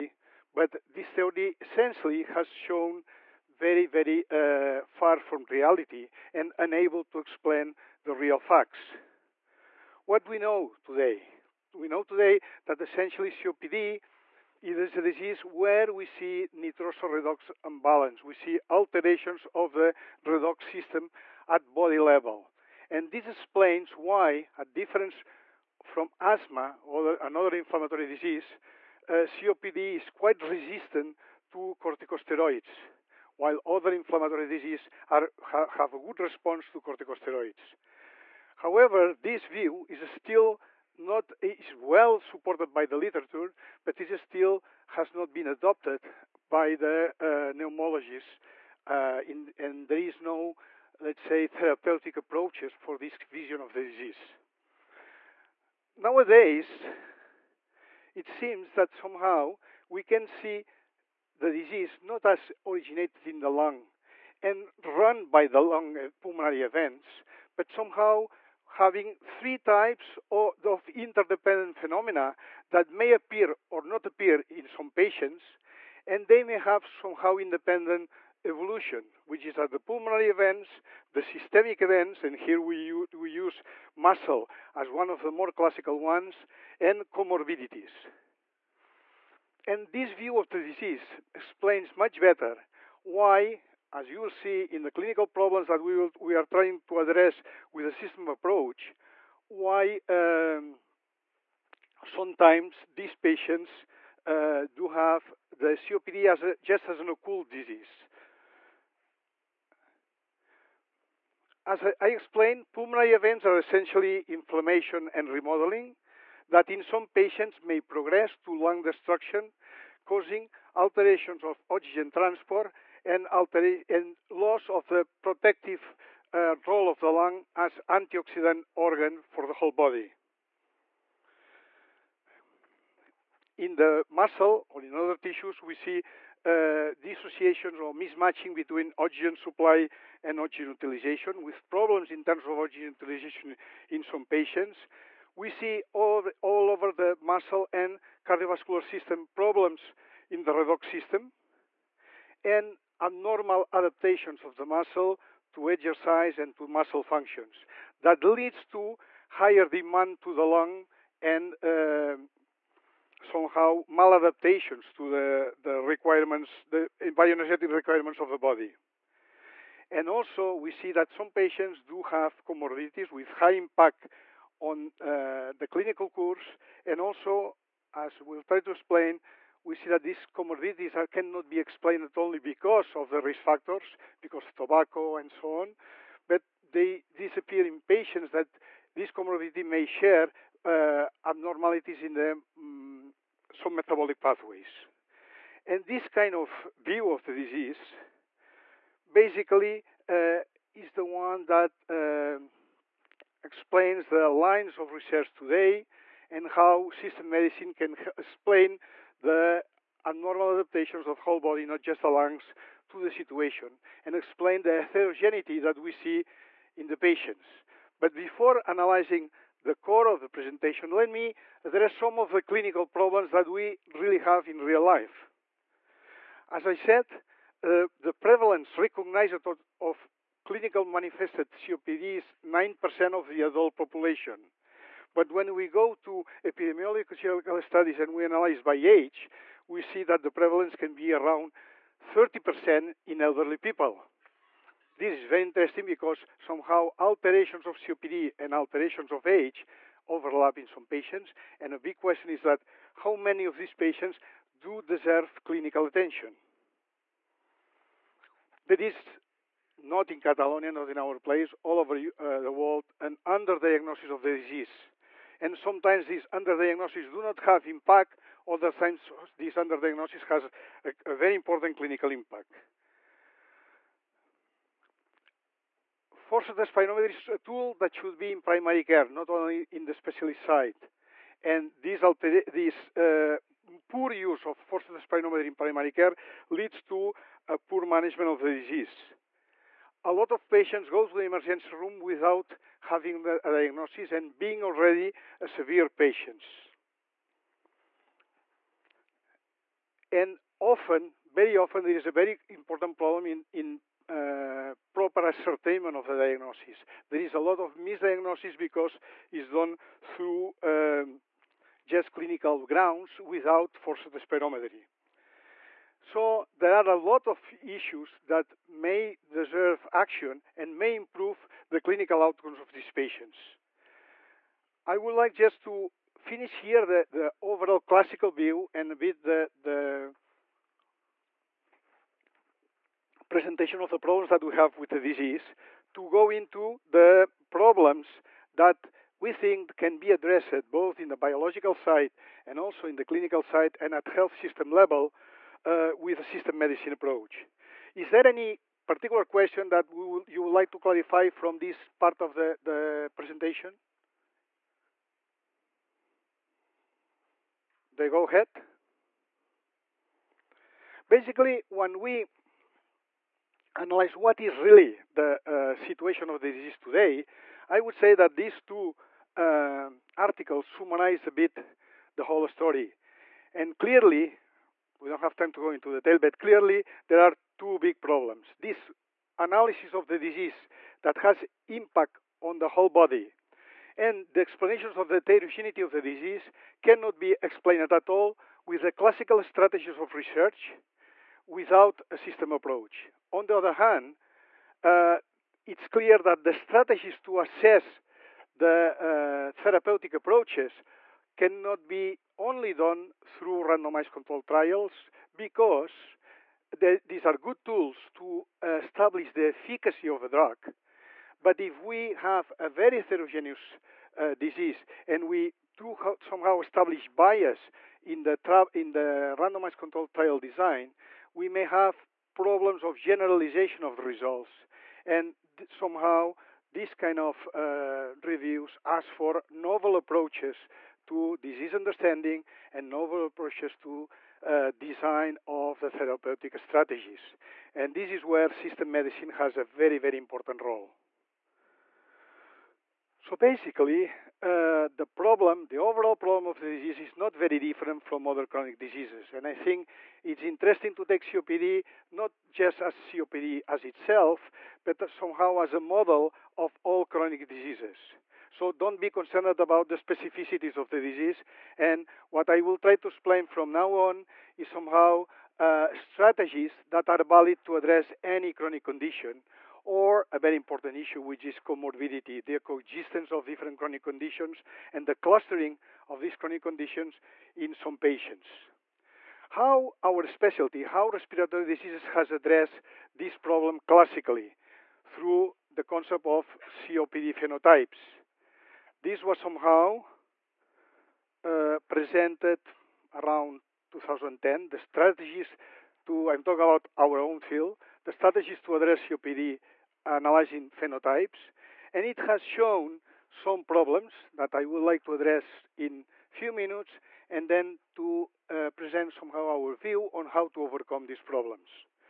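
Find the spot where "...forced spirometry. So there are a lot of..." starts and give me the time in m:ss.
5:13.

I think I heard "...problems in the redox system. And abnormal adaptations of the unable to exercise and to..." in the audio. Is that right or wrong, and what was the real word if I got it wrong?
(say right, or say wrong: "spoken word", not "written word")
wrong: "muscle", not "unable".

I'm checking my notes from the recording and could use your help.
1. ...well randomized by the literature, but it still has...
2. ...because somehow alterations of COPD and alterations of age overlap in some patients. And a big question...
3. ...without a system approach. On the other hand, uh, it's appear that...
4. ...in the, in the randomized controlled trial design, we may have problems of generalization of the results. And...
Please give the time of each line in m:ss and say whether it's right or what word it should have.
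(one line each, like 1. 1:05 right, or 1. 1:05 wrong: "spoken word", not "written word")
1. 0:41 wrong: "supported", not "randomized"
2. 4:05 right
3. 6:31 wrong: "clear", not "appear"
4. 6:58 right.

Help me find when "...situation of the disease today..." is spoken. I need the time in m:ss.
6:05.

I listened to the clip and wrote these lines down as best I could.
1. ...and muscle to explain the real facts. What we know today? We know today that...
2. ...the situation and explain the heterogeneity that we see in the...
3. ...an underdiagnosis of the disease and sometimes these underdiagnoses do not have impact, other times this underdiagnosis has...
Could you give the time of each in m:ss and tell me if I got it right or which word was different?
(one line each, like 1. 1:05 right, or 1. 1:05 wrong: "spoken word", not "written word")
1. 0:06 wrong: "unable", not "muscle"
2. 3:32 right
3. 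4:23 right.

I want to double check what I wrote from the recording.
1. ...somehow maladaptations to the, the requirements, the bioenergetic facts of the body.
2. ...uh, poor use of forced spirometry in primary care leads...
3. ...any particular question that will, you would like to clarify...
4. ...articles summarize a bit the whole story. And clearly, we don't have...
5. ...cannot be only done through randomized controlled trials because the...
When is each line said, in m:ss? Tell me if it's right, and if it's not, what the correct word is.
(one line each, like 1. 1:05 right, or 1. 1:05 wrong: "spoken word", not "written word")
1. 2:43 wrong: "requirements", not "facts"
2. 4:42 right
3. 5:48 right
4. 6:10 right
5. 6:41 right.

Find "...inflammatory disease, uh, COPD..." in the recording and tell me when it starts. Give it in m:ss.
0:27.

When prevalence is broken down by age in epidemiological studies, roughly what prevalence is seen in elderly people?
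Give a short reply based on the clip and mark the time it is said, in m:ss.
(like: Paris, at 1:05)
30%, at 4:02.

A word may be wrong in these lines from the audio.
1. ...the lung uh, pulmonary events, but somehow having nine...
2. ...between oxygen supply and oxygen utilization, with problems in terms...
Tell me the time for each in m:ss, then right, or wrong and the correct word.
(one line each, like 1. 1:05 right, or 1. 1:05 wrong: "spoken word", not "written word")
1. 1:05 wrong: "three", not "nine"
2. 2:18 right.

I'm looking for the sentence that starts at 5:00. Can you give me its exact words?
And often, very often, there is a very important problem in, in uh, proper ascertainment of the diagnosis.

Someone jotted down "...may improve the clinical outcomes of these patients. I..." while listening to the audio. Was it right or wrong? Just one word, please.
right.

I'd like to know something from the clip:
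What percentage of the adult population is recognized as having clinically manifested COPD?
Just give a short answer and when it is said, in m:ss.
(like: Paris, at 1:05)
9%, at 3:52.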